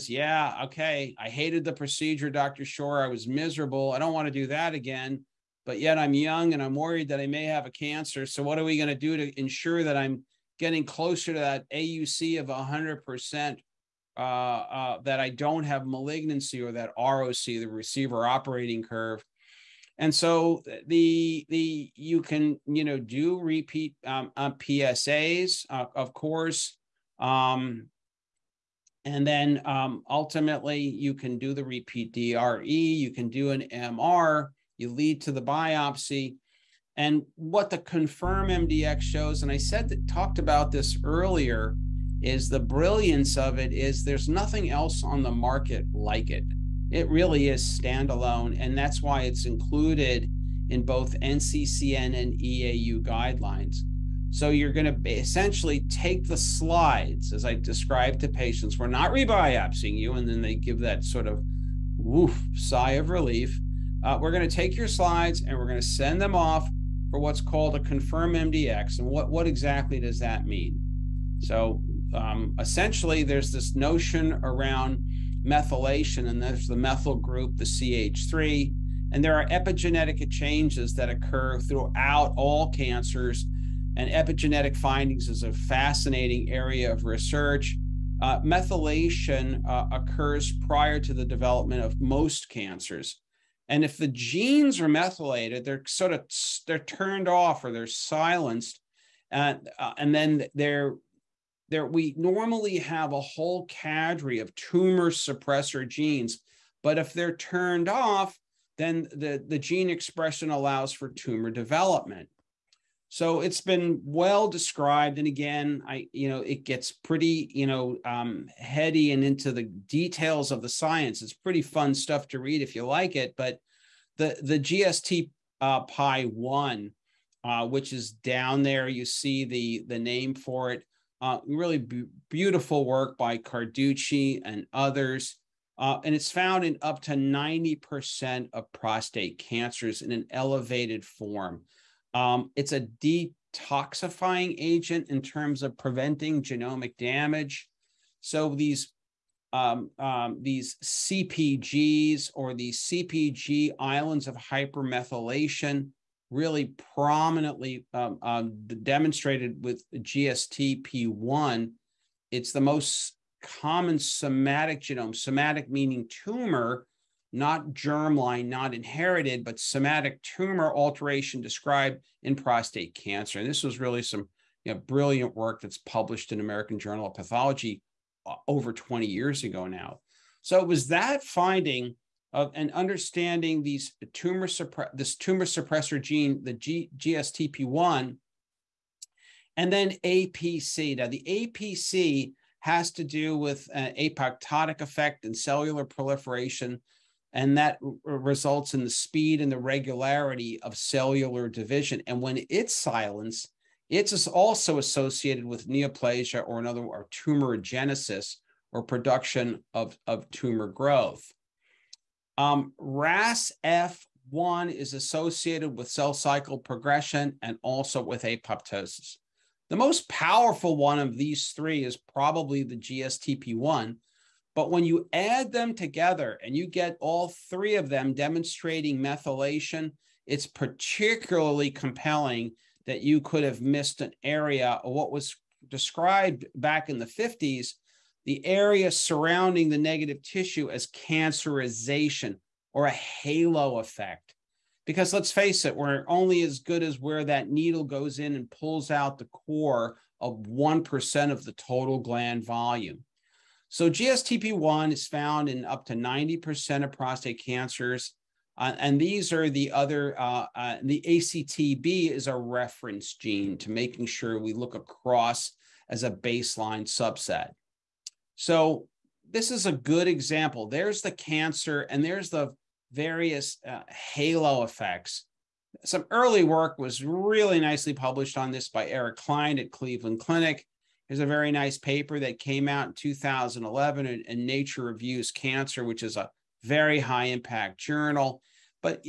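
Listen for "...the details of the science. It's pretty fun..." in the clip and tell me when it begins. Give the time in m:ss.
1:59.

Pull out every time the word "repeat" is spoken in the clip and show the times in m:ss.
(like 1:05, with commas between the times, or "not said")
0:23, 0:31.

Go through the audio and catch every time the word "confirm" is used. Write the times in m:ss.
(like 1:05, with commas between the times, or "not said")
0:37, 1:07.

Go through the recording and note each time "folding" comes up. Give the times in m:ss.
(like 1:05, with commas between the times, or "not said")
not said.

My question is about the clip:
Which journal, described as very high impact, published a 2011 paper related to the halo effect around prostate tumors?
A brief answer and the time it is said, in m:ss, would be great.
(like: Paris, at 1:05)
Nature Reviews Cancer, at 4:44.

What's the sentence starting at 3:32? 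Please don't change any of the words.
Um, RAS F1 is associated with cell cycle progression and also with apoptosis.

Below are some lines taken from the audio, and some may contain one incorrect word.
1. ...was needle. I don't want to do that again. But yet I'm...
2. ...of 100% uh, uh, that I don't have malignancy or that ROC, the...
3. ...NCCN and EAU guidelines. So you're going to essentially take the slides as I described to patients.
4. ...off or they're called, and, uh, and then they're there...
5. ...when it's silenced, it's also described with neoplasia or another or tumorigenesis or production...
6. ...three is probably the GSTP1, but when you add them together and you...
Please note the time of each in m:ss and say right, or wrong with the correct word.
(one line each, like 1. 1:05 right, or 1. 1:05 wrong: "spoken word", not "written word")
1. 0:03 wrong: "miserable", not "needle"
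2. 0:12 right
3. 0:51 right
4. 1:37 wrong: "silenced", not "called"
5. 3:22 wrong: "associated", not "described"
6. 3:41 right.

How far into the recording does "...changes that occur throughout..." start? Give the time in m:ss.
1:20.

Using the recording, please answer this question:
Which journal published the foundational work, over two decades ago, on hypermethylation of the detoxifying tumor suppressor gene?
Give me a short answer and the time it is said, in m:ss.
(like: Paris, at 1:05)
American Journal of Pathology, at 2:56.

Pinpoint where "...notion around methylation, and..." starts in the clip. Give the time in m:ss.
1:13.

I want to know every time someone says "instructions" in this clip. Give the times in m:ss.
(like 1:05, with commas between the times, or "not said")
not said.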